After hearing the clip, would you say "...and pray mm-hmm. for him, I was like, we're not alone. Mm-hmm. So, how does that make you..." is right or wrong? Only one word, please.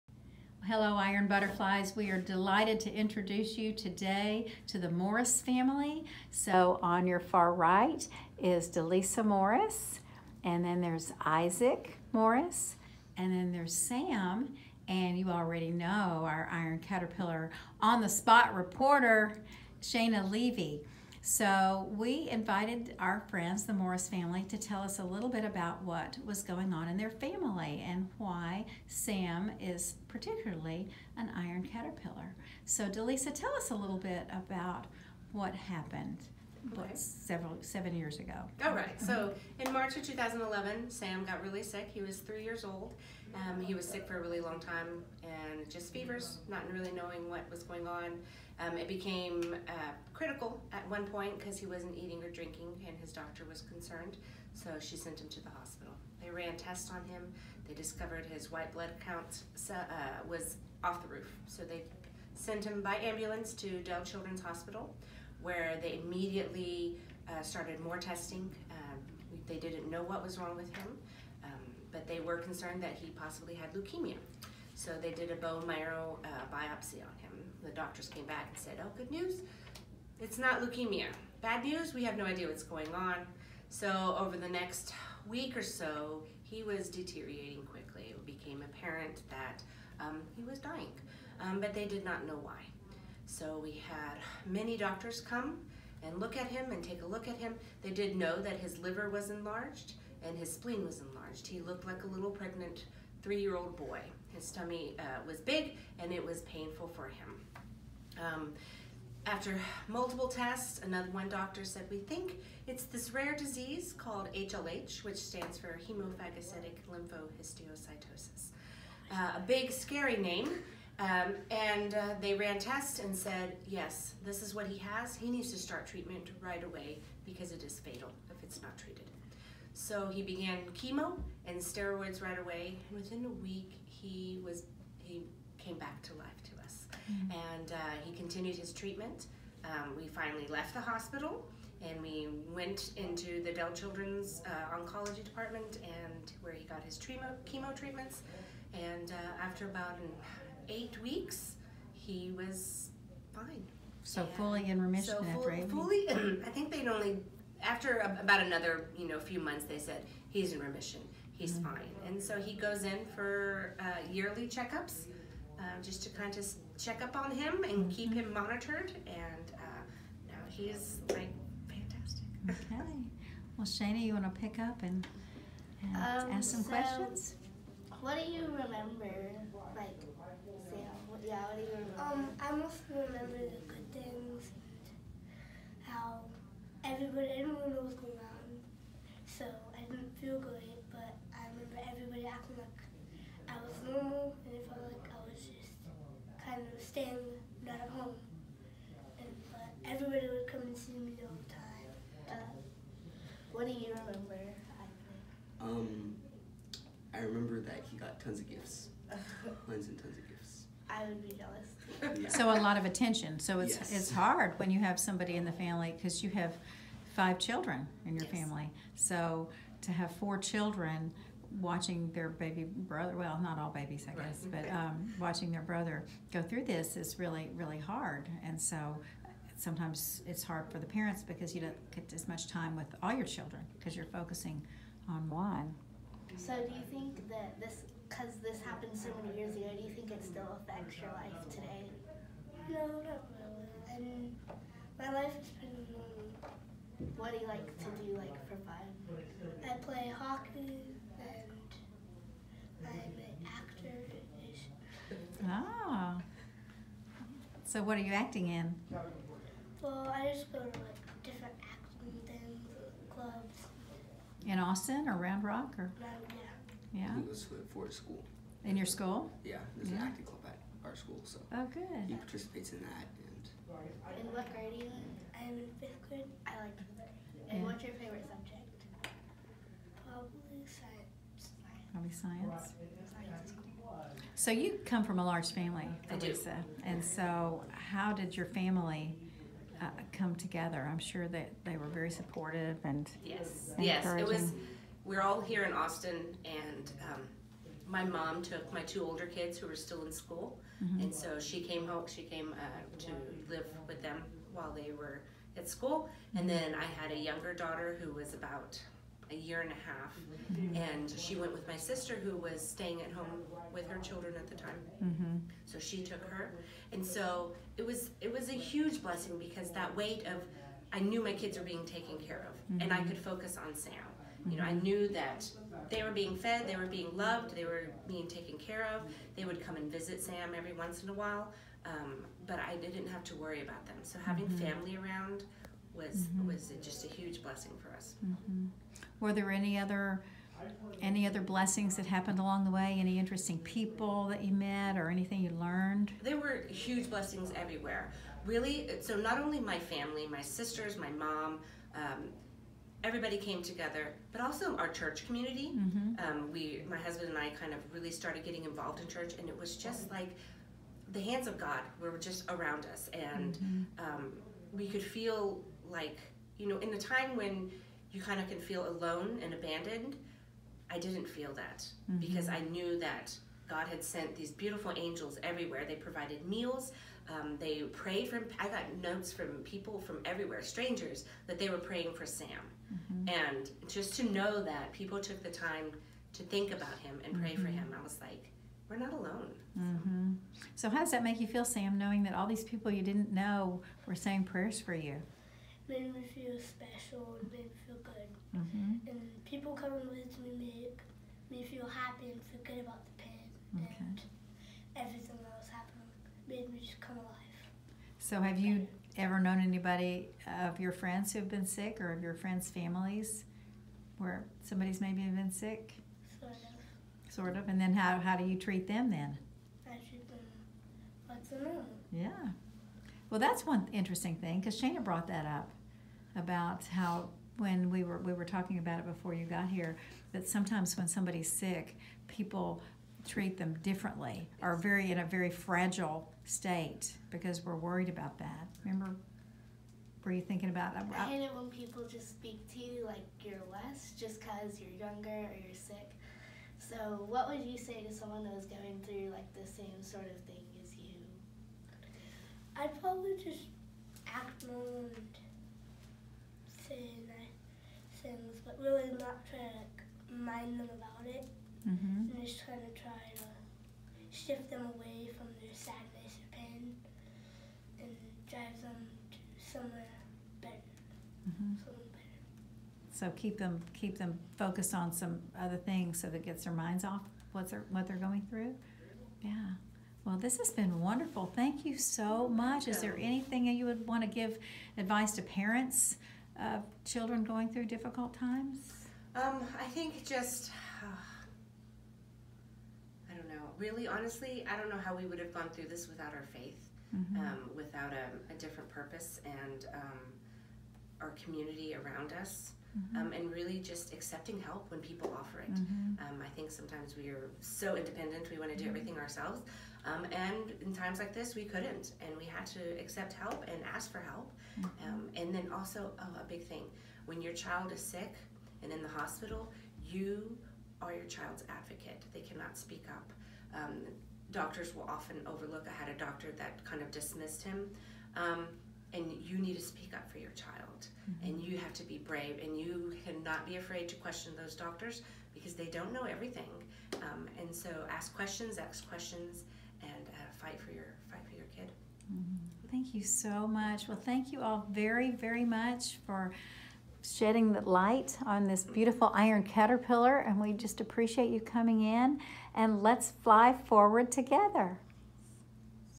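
right.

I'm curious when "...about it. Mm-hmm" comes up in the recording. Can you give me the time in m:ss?
7:40.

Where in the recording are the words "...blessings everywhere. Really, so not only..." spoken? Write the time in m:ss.
5:47.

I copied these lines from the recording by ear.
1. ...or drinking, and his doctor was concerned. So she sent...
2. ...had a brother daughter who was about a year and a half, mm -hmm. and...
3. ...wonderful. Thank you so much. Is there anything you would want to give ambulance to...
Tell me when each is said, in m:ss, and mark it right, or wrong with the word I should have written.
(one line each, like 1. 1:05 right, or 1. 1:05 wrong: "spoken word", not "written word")
1. 0:52 right
2. 5:06 wrong: "younger", not "brother"
3. 8:01 wrong: "advice", not "ambulance".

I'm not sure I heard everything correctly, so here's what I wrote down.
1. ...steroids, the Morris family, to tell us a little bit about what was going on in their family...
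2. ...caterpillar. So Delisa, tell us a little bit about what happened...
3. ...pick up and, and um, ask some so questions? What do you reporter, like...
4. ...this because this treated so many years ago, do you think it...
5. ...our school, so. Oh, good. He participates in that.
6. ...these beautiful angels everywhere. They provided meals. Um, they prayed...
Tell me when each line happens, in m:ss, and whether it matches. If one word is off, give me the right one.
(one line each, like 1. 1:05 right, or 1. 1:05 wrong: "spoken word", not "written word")
1. 0:23 wrong: "friends", not "steroids"
2. 0:31 right
3. 2:54 wrong: "remember", not "reporter"
4. 3:57 wrong: "happened", not "treated"
5. 4:30 right
6. 6:14 right.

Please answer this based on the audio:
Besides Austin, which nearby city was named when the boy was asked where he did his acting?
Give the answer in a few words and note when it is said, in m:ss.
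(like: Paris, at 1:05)
Round Rock, at 4:25.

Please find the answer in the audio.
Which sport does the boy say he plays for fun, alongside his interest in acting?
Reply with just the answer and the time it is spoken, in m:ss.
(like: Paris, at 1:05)
Hockey, at 4:10.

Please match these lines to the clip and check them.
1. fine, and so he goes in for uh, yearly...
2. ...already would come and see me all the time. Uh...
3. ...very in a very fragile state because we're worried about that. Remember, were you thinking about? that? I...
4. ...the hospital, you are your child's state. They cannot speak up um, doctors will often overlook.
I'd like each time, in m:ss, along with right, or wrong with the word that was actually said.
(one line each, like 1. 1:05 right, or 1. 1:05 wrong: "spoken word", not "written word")
1. 2:41 right
2. 3:19 wrong: "everybody", not "already"
3. 7:14 right
4. 8:39 wrong: "advocate", not "state".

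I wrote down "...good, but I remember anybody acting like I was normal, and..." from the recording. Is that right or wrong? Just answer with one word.
wrong.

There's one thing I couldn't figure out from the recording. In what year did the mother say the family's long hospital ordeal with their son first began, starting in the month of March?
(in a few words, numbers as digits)
2011.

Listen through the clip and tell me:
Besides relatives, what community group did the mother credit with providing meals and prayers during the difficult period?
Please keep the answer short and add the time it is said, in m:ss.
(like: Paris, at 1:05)
Church community, at 5:54.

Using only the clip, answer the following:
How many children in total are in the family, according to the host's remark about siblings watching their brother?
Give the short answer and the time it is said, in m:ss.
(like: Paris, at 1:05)
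5, at 3:37.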